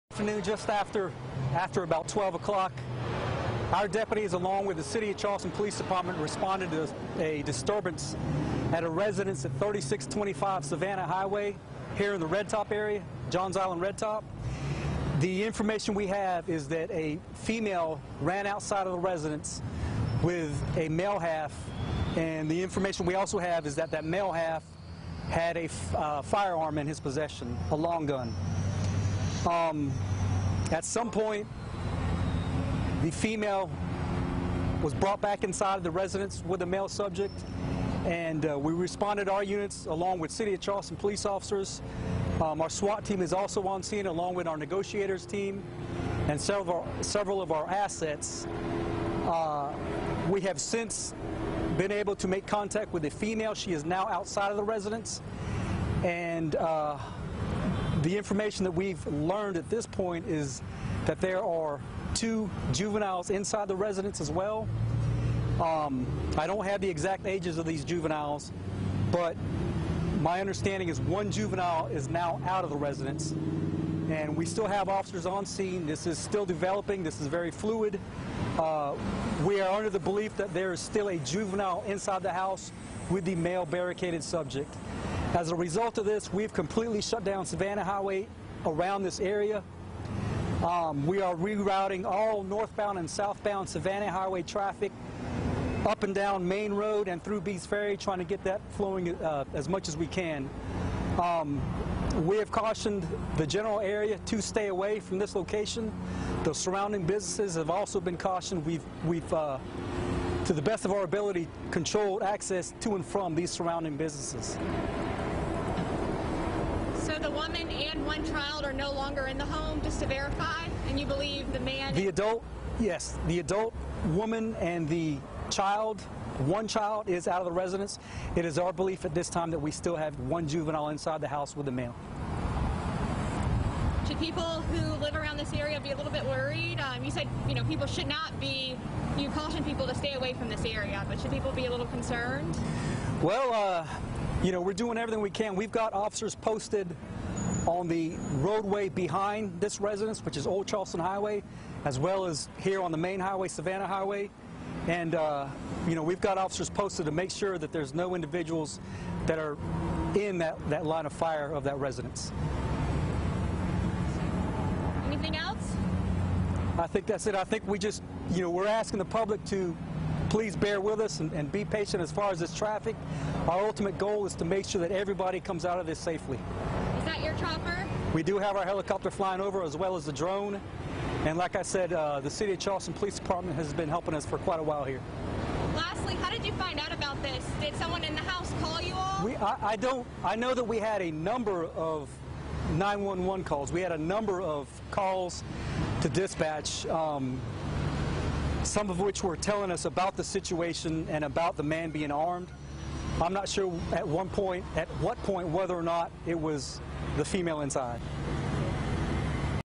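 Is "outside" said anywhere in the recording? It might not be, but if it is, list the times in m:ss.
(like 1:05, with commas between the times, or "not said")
0:18, 0:54.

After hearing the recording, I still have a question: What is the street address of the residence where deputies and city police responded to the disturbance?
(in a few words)
3625 Savannah Highway.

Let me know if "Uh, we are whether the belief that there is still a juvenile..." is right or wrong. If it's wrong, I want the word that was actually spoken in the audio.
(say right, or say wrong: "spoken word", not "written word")
wrong: "under", not "whether".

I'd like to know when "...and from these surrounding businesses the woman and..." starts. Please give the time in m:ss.
1:52.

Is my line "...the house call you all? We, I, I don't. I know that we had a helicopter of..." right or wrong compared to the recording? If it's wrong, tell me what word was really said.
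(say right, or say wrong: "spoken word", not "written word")
wrong: "number", not "helicopter".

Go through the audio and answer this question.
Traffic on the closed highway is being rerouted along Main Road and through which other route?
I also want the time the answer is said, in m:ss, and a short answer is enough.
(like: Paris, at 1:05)
Bees Ferry, at 1:37.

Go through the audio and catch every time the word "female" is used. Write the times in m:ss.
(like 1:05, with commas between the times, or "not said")
0:17, 0:33, 0:53, 3:27.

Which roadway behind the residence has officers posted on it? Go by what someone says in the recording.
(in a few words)
Old Charleston Highway.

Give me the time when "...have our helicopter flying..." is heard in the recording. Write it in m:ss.
2:58.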